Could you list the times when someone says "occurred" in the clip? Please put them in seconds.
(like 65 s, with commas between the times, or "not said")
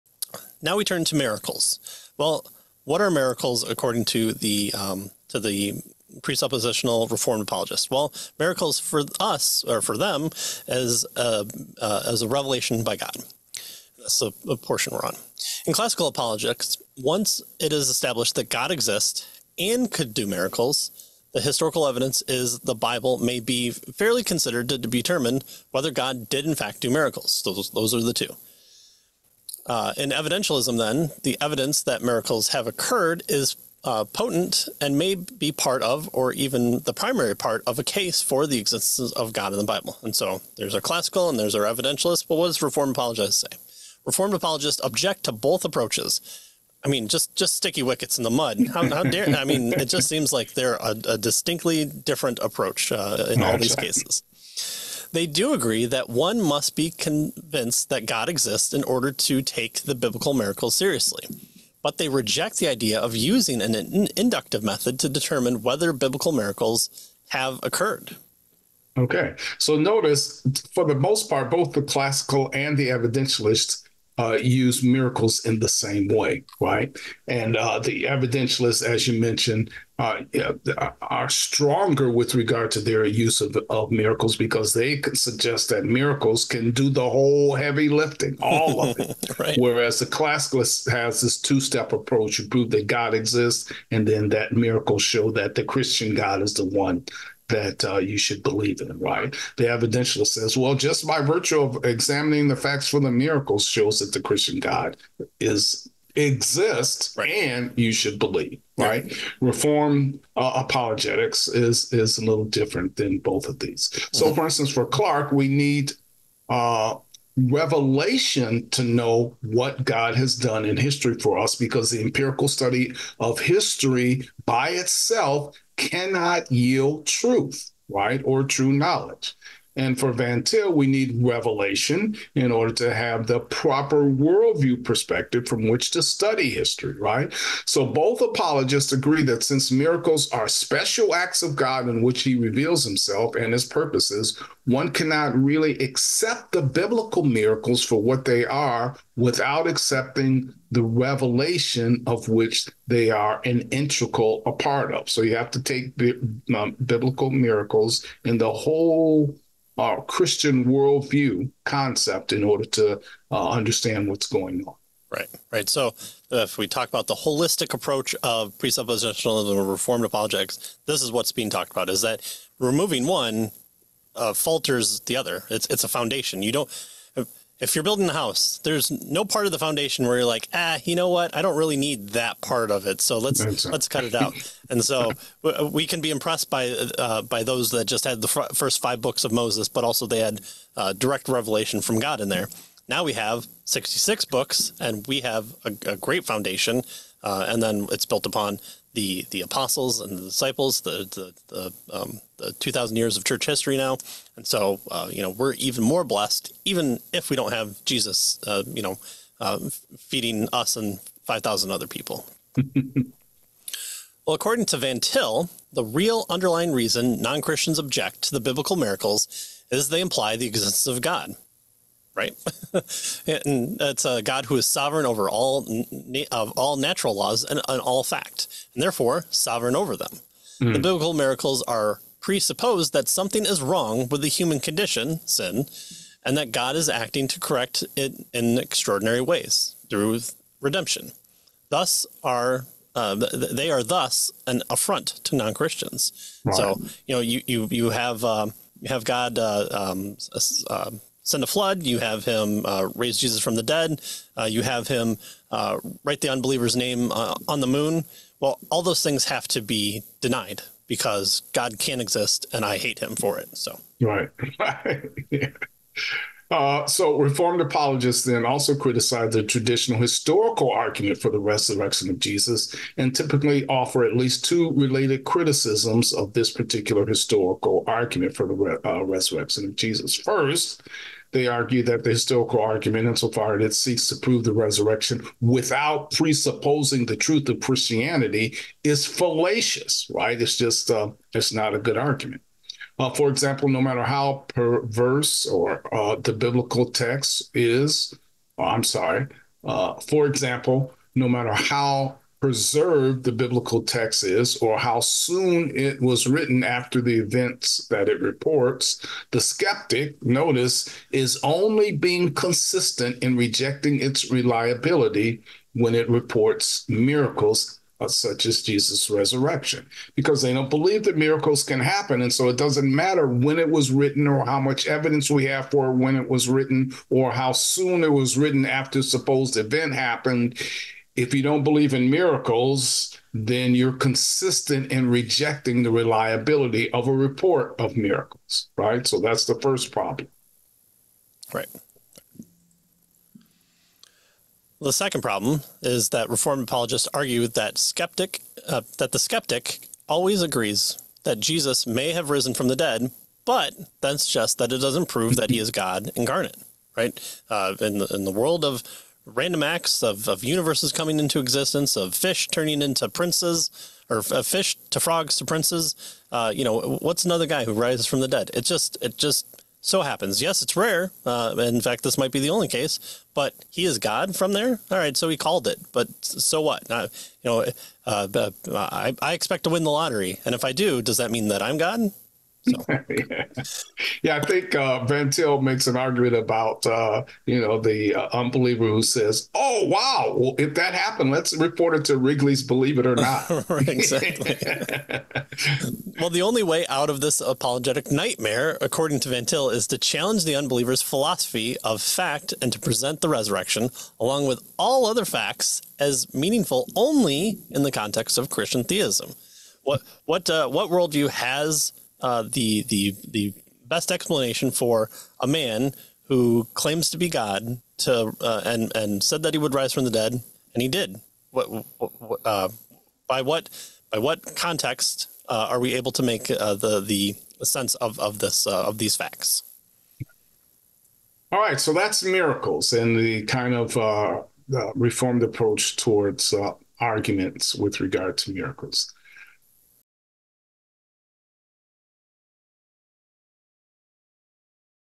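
32 s, 67 s.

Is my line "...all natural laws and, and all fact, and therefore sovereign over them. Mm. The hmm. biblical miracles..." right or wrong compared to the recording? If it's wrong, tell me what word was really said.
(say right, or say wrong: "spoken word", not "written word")
right.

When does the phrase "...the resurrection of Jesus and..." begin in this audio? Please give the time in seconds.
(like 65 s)
271 s.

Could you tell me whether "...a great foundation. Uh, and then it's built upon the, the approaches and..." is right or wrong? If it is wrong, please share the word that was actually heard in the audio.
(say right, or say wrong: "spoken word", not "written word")
wrong: "apostles", not "approaches".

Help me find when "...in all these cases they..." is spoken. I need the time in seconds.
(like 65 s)
53 s.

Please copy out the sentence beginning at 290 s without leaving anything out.
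It's just, uh, it's not a good argument.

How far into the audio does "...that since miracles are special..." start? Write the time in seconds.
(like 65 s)
139 s.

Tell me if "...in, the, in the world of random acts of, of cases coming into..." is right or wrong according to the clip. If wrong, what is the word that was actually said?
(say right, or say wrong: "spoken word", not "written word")
wrong: "universes", not "cases".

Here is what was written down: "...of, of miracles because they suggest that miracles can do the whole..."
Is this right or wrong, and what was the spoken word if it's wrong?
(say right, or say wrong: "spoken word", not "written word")
right.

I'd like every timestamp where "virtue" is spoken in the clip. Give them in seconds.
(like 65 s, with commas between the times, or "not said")
101 s.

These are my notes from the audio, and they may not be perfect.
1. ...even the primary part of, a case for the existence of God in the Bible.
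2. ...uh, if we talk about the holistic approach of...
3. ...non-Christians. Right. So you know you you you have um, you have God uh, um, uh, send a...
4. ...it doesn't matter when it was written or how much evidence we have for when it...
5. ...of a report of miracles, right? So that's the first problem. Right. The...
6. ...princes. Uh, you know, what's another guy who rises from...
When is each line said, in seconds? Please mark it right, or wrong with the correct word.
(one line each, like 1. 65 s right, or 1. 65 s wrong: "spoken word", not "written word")
1. 36 s right
2. 166 s right
3. 245 s right
4. 322 s right
5. 336 s right
6. 365 s right.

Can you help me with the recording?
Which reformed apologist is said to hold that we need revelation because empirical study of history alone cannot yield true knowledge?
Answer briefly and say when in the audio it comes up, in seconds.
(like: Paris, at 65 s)
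Clark, at 114 s.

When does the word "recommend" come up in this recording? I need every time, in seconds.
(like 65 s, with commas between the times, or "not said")
not said.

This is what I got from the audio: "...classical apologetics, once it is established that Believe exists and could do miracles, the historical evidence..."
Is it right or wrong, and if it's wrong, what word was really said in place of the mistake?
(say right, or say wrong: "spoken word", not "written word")
wrong: "God", not "Believe".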